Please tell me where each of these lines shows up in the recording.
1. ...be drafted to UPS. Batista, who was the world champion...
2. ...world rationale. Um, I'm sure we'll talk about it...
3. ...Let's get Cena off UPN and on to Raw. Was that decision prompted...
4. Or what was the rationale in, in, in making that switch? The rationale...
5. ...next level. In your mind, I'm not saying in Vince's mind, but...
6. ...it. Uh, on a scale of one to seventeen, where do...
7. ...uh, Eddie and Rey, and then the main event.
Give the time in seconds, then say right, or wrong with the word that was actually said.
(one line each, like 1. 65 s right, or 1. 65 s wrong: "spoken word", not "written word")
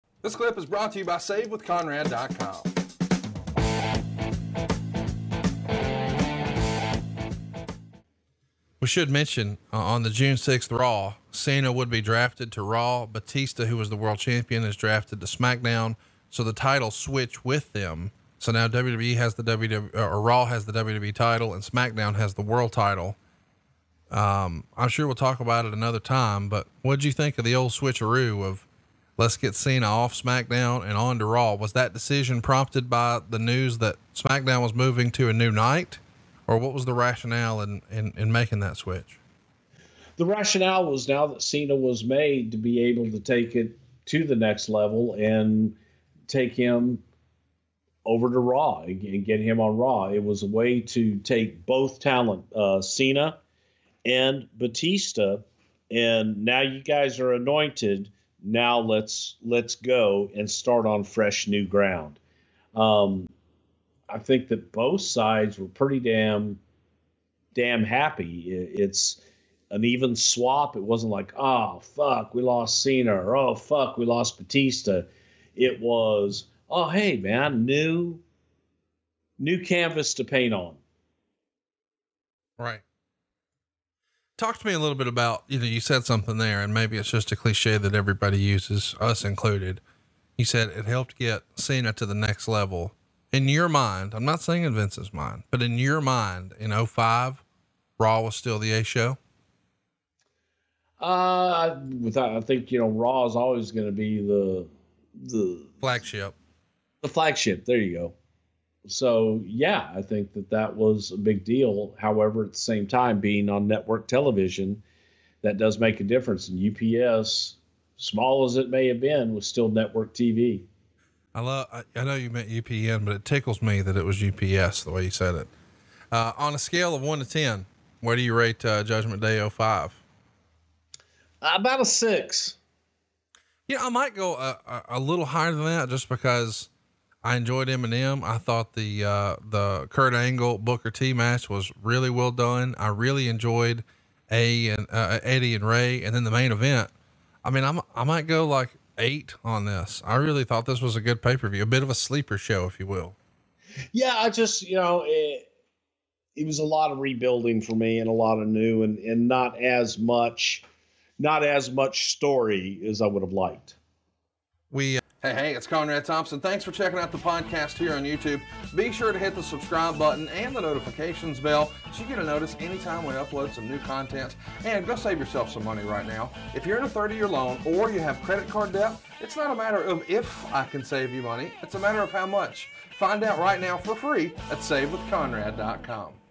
1. 11 s wrong: "Raw", not "UPS"
2. 22 s wrong: "title", not "rationale"
3. 29 s wrong: "SmackDown", not "UPN"
4. 36 s right
5. 92 s right
6. 125 s wrong: "ten", not "seventeen"
7. 144 s right.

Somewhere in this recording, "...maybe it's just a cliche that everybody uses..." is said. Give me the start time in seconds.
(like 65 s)
86 s.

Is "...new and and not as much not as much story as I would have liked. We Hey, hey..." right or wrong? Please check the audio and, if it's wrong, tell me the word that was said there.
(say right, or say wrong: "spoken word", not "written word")
right.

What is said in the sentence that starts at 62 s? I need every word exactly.
Um, I think that both sides were pretty damn damn happy.